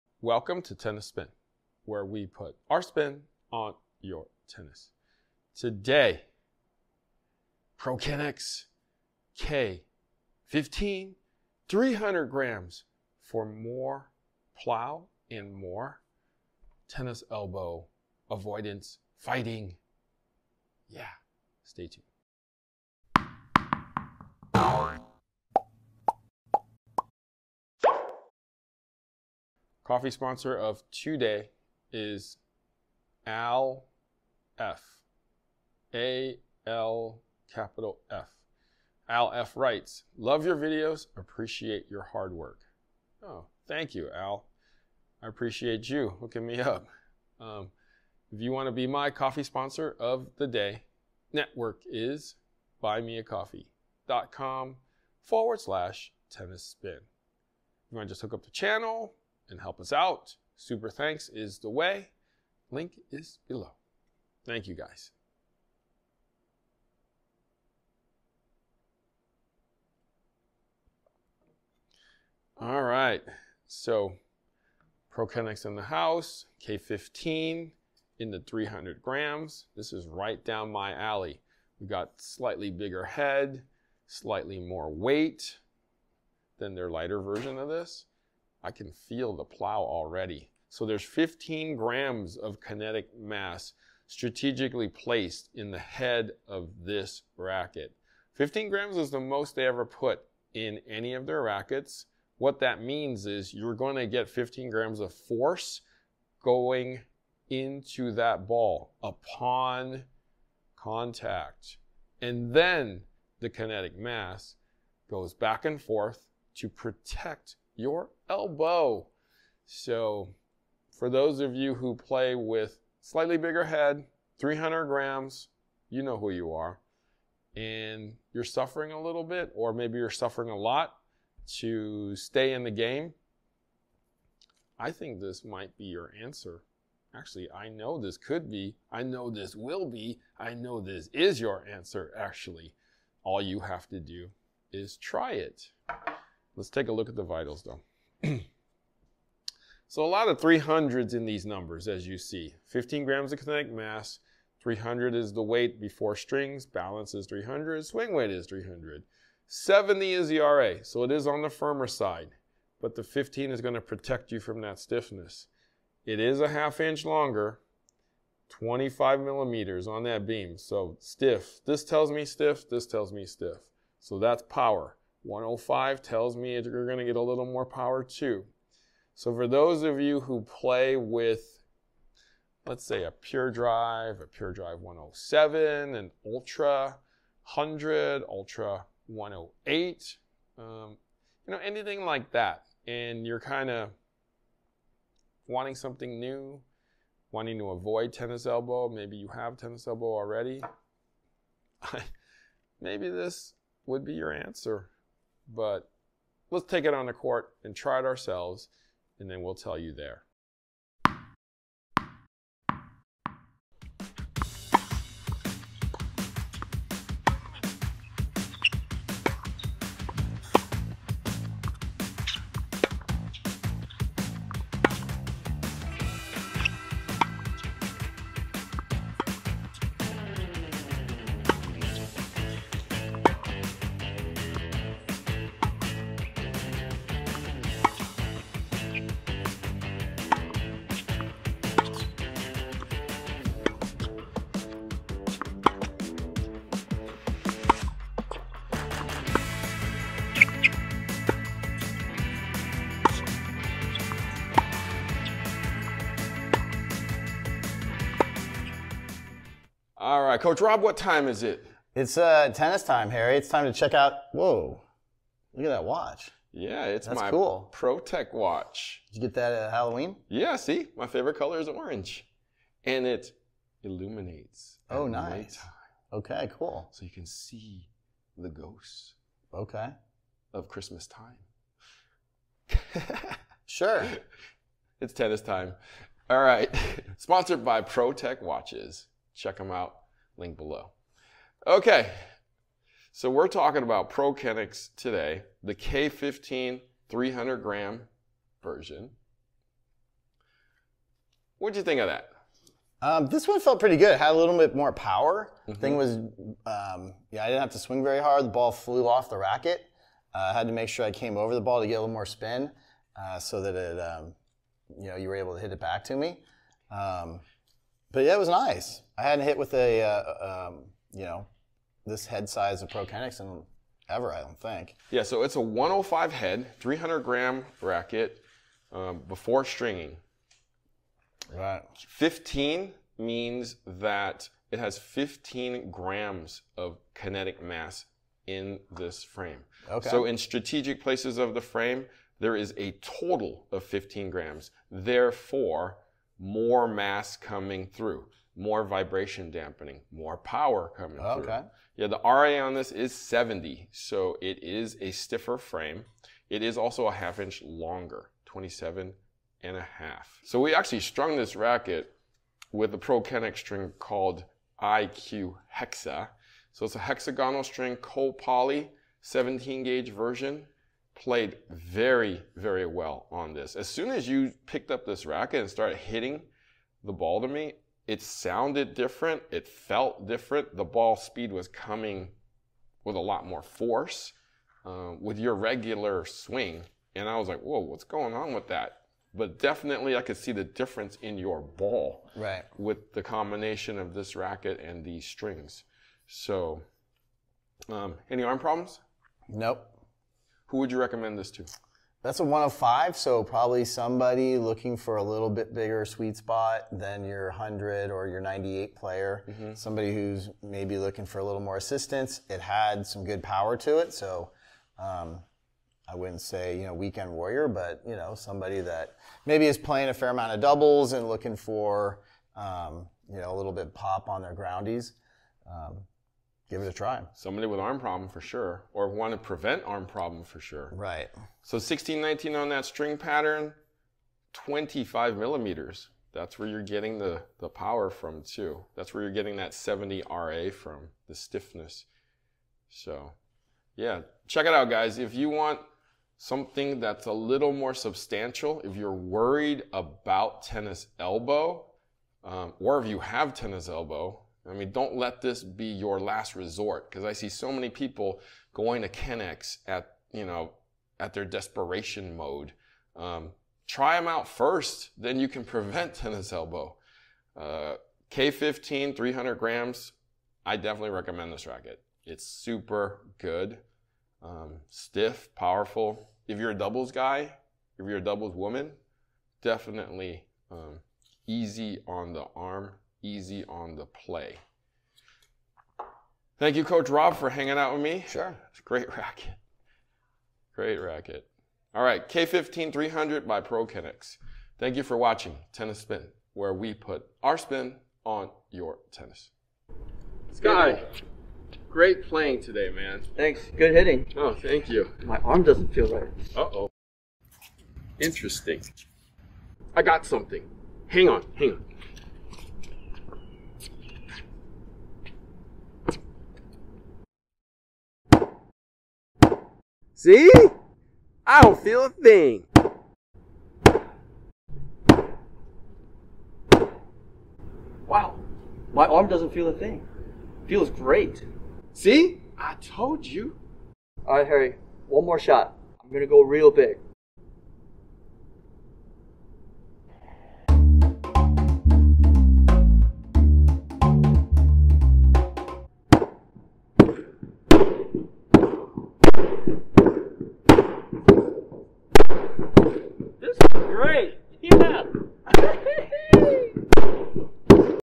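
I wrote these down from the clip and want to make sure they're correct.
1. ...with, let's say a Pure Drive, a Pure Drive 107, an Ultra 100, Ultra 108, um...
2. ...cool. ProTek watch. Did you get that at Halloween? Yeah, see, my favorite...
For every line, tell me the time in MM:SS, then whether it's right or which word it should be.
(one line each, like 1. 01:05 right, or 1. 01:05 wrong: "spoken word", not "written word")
1. 03:00 right
2. 04:27 right.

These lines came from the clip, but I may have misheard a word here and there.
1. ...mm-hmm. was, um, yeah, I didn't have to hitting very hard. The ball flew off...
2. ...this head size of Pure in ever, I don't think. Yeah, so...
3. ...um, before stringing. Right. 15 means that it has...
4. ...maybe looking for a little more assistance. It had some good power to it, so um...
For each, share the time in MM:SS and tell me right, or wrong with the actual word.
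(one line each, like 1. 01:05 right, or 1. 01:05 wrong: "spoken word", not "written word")
1. 05:05 wrong: "swing", not "hitting"
2. 05:22 wrong: "Prokinetics", not "Pure"
3. 05:28 right
4. 06:50 right.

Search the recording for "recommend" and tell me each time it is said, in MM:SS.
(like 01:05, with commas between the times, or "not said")
06:40, 07:51.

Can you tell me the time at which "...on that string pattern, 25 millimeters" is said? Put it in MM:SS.
07:12.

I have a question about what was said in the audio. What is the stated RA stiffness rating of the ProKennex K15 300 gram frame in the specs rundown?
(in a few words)
70.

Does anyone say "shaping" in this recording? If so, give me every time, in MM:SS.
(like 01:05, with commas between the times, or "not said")
not said.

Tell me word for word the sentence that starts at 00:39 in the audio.
Al F writes, Love your videos, appreciate your hard work.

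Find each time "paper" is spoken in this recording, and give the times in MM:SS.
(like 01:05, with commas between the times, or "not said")
not said.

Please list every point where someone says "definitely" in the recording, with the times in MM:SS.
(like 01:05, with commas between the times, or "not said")
06:29, 07:50, 07:59.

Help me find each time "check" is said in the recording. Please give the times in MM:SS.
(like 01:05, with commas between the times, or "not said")
04:23, 04:49, 07:24.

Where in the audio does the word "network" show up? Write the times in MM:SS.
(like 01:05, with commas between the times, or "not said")
00:51.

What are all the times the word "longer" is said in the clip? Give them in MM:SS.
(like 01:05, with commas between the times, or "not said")
02:47, 05:57.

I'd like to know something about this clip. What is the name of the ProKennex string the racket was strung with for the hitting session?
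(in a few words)
IQ Hexa.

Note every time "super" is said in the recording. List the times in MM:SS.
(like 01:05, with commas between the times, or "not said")
01:00, 07:52.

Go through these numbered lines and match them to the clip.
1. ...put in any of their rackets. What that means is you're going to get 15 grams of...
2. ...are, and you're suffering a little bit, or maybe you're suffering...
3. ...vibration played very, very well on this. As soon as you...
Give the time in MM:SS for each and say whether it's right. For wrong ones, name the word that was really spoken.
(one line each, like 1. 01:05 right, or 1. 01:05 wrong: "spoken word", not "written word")
1. 01:39 right
2. 02:06 right
3. 06:10 wrong: "version", not "vibration".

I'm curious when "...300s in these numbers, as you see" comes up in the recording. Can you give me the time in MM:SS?
02:30.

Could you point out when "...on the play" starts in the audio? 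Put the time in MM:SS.
08:03.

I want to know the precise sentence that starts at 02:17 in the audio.
Actually, I know this could be.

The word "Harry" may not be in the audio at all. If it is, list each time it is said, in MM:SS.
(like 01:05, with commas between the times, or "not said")
04:23, 08:54.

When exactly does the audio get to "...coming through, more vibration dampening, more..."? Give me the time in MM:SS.
05:47.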